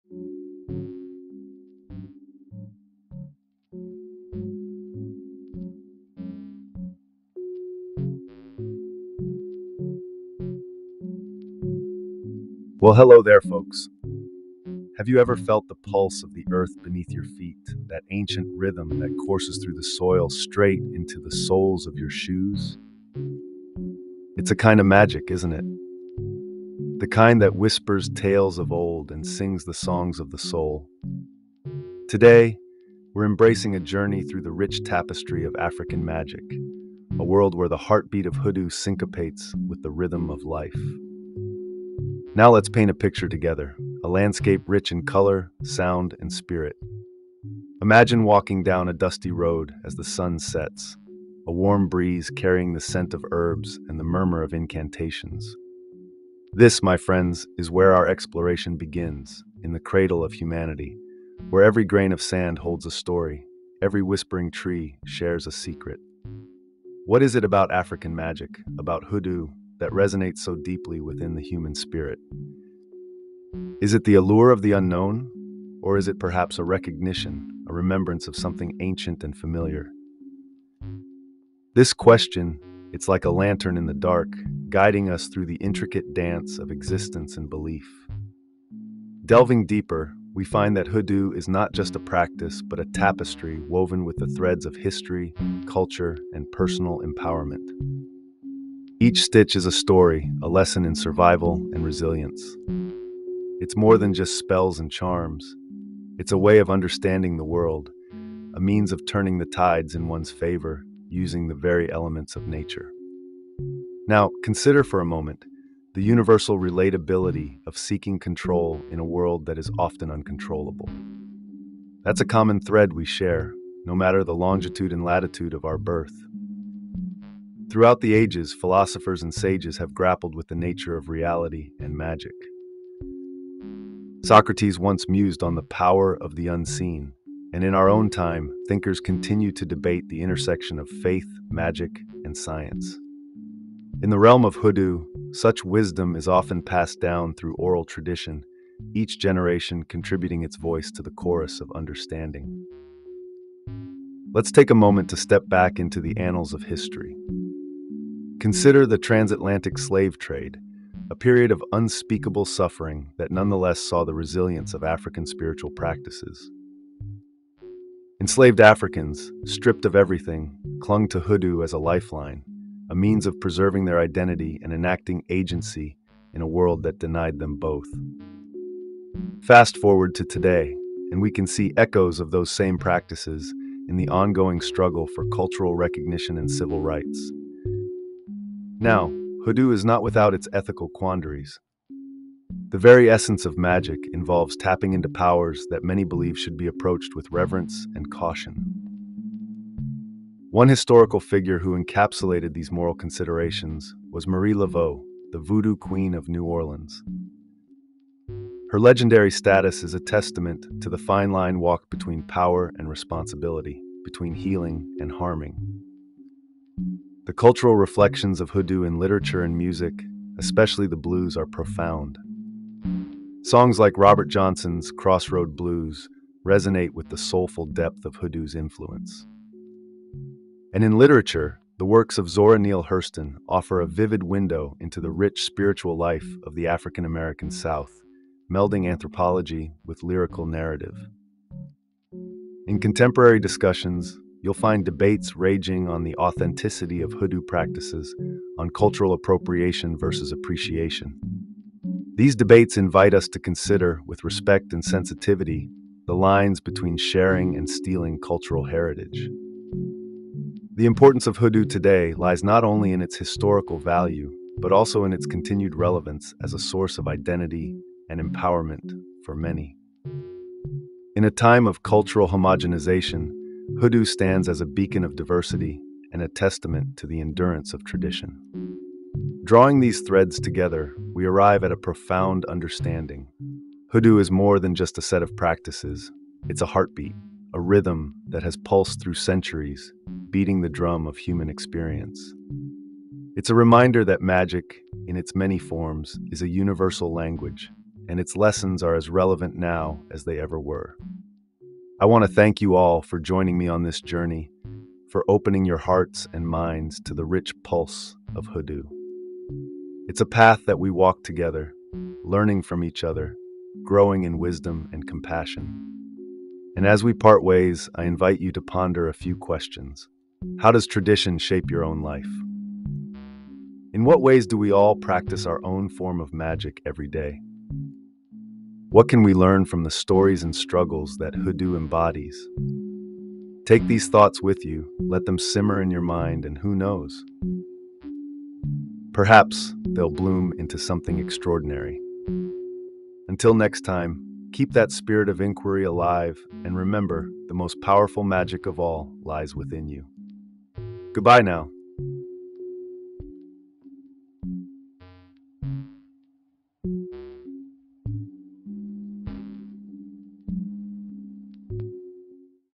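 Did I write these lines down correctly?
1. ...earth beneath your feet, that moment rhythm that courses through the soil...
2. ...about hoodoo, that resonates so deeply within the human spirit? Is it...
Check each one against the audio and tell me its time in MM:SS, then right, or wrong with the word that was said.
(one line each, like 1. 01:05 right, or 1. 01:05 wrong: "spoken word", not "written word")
1. 00:16 wrong: "ancient", not "moment"
2. 01:08 right.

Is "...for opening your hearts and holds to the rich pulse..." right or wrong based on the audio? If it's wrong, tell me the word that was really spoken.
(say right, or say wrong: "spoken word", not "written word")
wrong: "minds", not "holds".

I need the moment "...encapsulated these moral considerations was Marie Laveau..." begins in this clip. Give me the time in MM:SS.
03:21.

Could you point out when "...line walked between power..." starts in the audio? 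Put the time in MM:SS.
03:31.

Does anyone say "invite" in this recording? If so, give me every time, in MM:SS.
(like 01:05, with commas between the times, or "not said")
04:12, 05:18.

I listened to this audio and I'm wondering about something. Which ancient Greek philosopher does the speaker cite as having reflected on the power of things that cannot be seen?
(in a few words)
Socrates.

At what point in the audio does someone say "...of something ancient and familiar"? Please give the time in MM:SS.
01:18.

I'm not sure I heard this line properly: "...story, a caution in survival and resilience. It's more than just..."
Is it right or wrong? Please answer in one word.
wrong.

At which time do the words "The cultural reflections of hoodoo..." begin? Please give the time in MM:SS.
03:37.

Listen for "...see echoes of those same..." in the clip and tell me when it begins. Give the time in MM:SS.
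03:01.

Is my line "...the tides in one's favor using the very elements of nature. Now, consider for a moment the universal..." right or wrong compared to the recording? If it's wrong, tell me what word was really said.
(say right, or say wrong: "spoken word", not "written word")
right.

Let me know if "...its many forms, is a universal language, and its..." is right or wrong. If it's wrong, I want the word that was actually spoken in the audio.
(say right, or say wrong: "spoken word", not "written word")
right.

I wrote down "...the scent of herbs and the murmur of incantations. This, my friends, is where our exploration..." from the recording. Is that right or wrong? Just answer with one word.
right.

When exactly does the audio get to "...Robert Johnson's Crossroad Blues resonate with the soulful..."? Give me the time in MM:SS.
03:43.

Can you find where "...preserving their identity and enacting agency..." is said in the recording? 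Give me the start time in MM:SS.
02:53.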